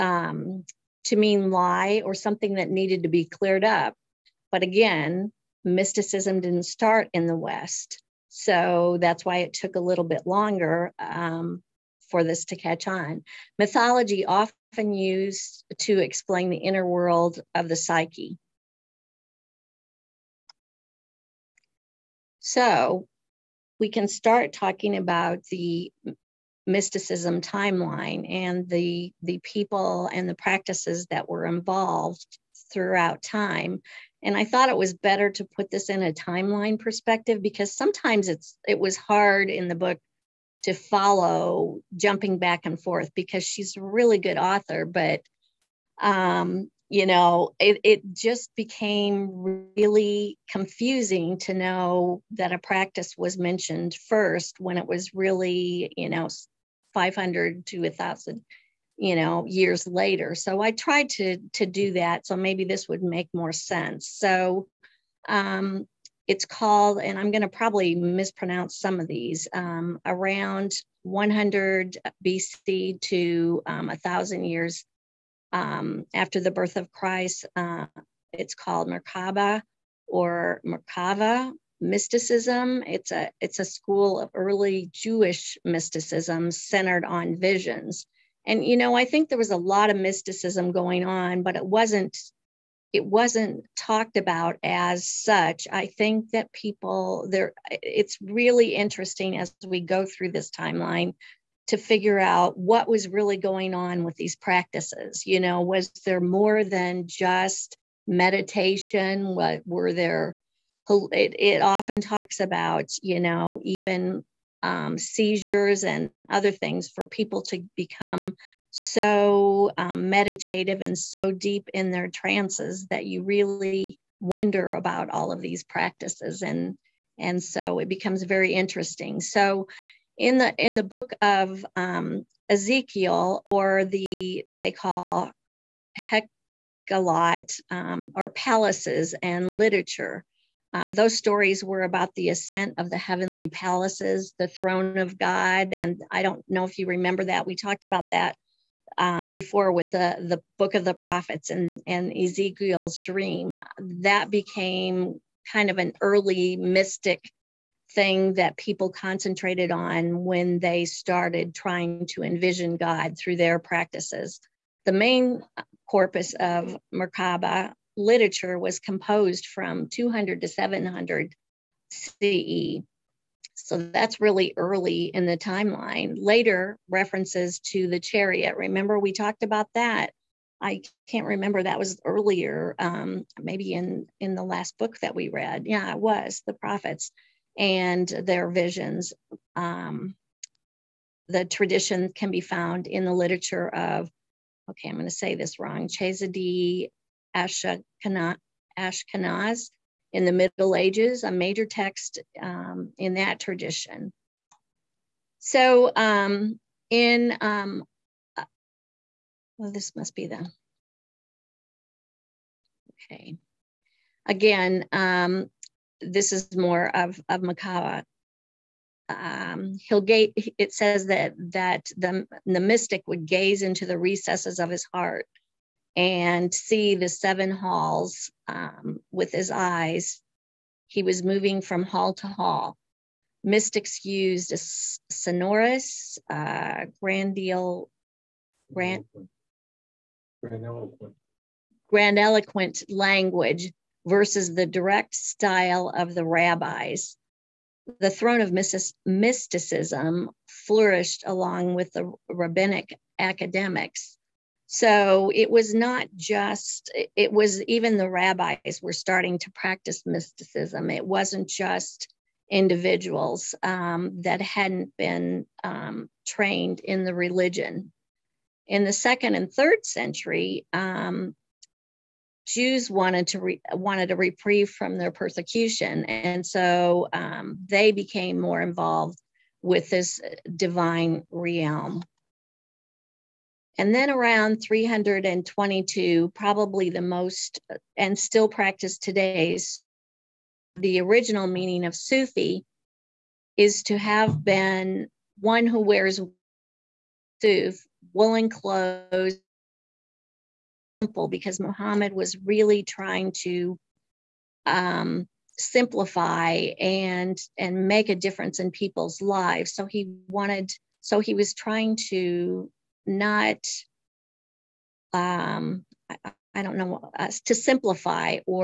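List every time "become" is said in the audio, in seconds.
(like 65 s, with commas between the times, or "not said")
117 s, 127 s.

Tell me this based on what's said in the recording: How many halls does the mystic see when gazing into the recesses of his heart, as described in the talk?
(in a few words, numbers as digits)
7.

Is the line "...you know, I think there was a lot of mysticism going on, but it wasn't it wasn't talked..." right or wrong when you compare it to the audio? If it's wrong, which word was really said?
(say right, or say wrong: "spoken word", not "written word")
right.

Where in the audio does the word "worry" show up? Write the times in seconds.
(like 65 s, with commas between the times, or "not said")
not said.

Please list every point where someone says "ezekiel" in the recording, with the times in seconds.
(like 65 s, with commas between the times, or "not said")
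132 s, 152 s.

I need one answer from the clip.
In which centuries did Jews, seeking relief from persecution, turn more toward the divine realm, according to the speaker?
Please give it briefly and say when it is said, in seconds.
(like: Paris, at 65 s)
Second and third century, at 268 s.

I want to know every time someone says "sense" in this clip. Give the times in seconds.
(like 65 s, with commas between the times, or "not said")
63 s.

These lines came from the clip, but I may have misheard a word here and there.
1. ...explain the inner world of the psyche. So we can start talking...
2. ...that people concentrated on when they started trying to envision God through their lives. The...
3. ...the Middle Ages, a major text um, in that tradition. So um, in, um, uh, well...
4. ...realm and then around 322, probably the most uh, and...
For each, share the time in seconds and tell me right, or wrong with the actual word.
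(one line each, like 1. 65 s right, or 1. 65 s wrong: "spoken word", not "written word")
1. 15 s right
2. 158 s wrong: "practices", not "lives"
3. 200 s right
4. 281 s right.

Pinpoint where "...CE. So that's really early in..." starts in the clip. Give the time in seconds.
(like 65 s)
171 s.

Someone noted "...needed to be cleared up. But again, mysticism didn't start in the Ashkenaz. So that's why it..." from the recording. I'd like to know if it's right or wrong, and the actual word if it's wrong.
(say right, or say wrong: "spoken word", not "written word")
wrong: "West", not "Ashkenaz".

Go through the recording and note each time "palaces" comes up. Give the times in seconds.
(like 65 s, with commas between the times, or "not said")
138 s, 143 s.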